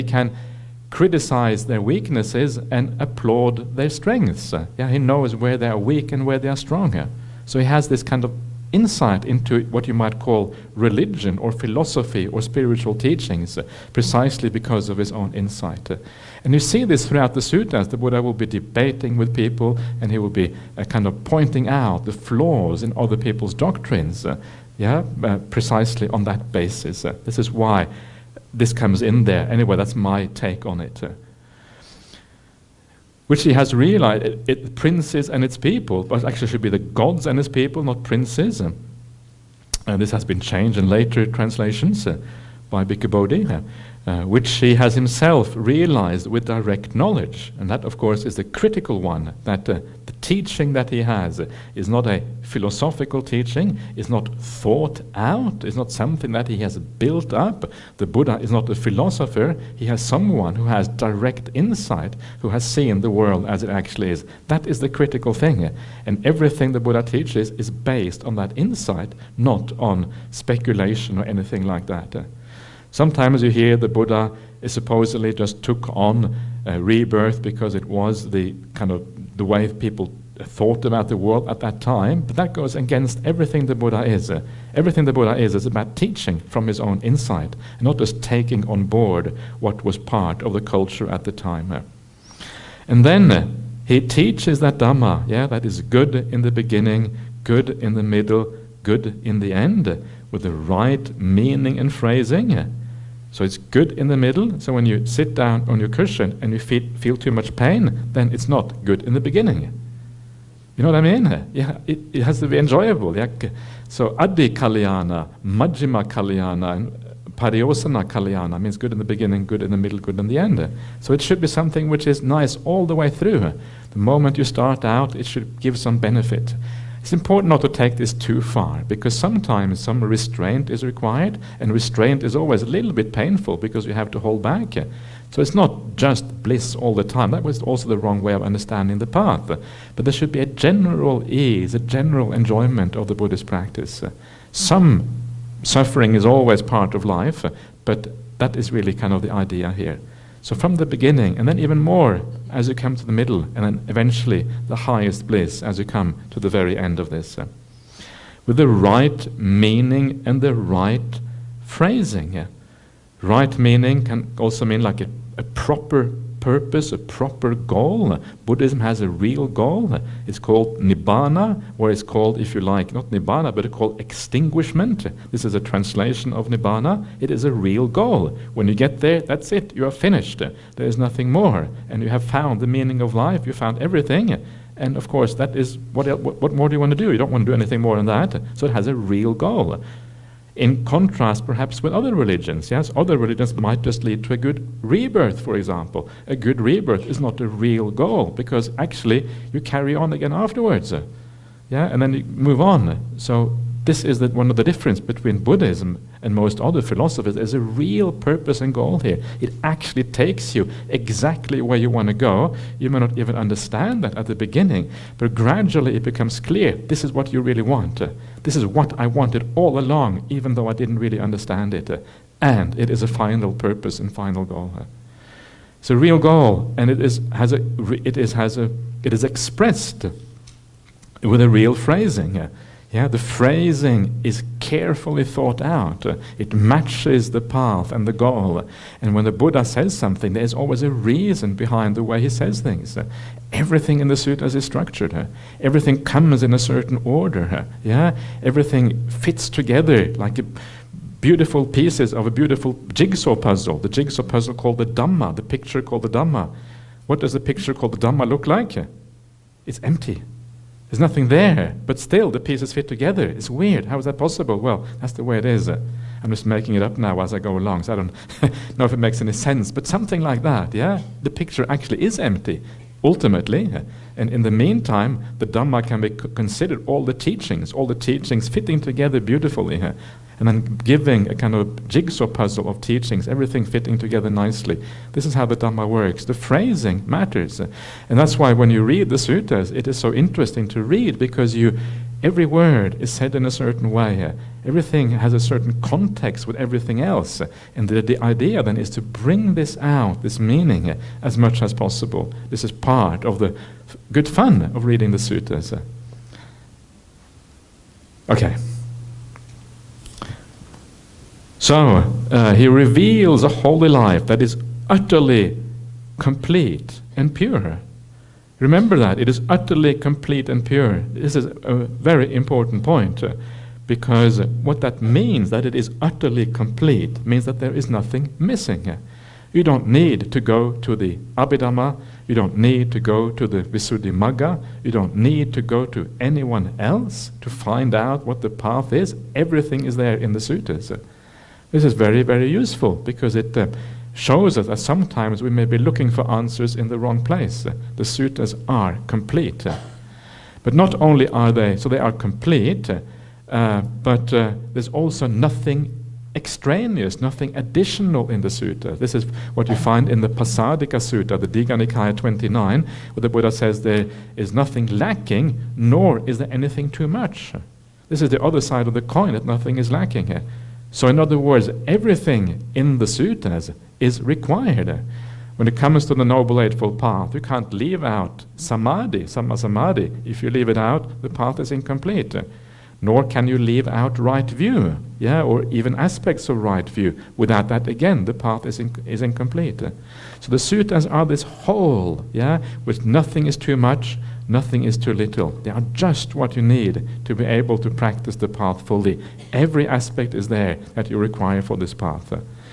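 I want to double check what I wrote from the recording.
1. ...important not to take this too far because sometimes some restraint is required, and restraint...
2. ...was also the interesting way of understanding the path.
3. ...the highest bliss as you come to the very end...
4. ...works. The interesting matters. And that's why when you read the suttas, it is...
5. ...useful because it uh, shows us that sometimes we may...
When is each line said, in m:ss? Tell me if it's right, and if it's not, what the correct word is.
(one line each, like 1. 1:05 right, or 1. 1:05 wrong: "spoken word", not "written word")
1. 2:07 right
2. 2:17 wrong: "wrong", not "interesting"
3. 2:34 right
4. 4:45 wrong: "phrasing", not "interesting"
5. 5:42 right.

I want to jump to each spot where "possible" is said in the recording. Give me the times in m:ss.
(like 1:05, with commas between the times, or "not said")
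4:24, 5:01.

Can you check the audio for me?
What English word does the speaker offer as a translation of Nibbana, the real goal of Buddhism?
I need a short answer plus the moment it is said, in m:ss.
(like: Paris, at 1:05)
extinguishment, at 2:54.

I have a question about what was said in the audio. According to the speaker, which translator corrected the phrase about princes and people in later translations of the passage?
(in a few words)
Bhikkhu Bodhi.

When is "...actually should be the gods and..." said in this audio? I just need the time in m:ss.
0:36.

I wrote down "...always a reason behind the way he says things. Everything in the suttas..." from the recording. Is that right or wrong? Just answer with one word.
right.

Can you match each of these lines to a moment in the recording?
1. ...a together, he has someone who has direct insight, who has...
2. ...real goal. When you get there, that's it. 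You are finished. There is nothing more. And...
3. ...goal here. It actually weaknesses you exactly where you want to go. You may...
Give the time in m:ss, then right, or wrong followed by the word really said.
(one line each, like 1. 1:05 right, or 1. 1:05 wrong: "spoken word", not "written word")
1. 0:58 wrong: "philosopher", not "together"
2. 2:57 right
3. 3:28 wrong: "takes", not "weaknesses".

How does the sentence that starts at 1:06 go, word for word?
And everything the Buddha teaches is based on that insight, not on speculation or anything like that.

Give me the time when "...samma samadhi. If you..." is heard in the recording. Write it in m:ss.
6:19.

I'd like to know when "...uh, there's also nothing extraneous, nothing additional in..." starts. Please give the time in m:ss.
5:54.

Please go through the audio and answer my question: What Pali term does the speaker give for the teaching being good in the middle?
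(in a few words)
Majjhima Kalyana.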